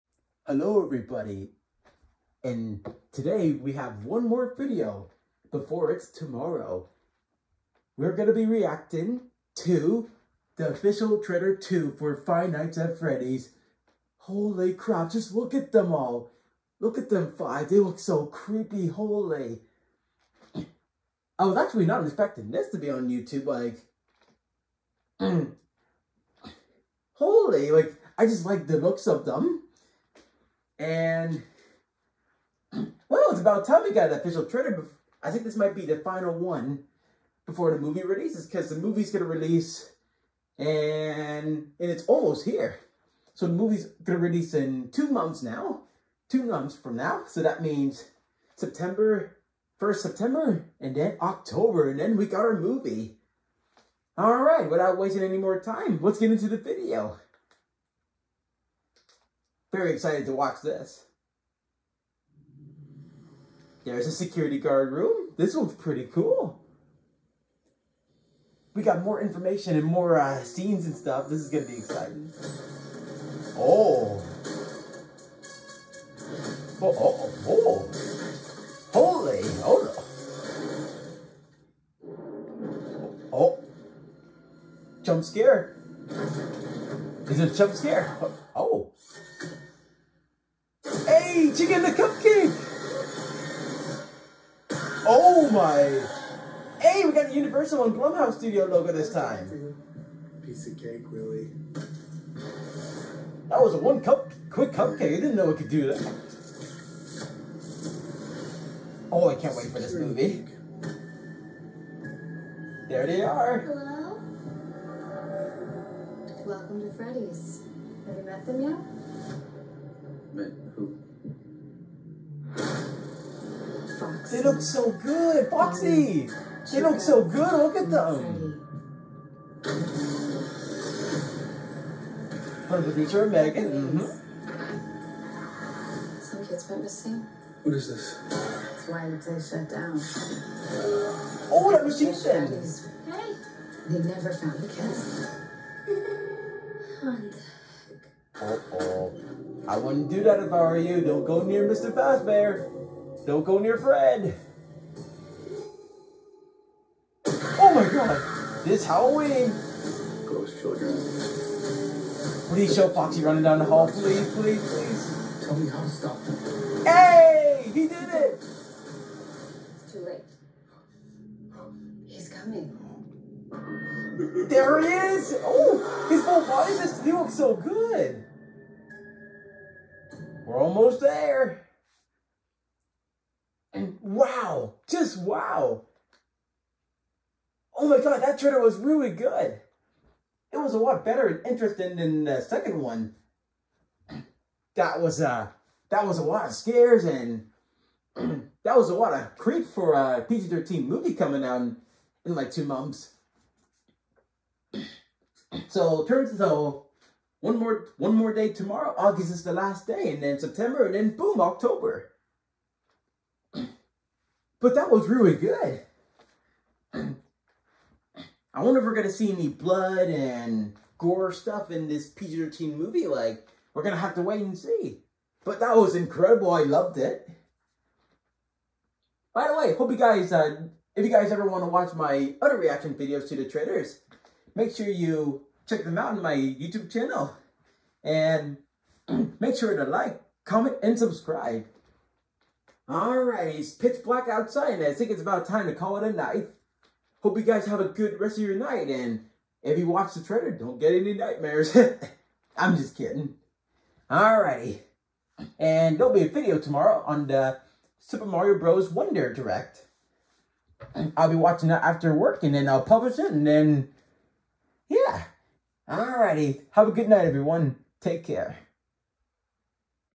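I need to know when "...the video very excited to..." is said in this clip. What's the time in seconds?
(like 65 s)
56 s.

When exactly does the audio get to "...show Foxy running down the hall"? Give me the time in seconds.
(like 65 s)
162 s.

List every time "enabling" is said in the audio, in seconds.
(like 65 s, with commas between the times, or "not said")
not said.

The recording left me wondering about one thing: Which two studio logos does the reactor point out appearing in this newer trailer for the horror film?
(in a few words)
Universal and Blumhouse.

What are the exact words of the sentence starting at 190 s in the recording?
It was a lot better and interesting than the second one.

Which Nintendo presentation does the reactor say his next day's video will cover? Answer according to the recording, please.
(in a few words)
Super Mario Bros. Wonder Direct.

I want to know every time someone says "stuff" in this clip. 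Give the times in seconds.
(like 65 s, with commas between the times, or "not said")
70 s, 221 s.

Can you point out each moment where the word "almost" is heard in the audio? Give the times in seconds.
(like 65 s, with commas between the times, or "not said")
42 s, 180 s.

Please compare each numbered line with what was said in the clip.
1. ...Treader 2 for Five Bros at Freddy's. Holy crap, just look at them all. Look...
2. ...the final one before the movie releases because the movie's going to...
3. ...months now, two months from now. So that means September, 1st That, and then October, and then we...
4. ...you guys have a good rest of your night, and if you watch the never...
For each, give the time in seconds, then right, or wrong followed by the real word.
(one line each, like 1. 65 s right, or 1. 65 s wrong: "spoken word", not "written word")
1. 11 s wrong: "Nights", not "Bros"
2. 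35 s right
3. 45 s wrong: "September", not "That"
4. 247 s wrong: "trailer", not "never".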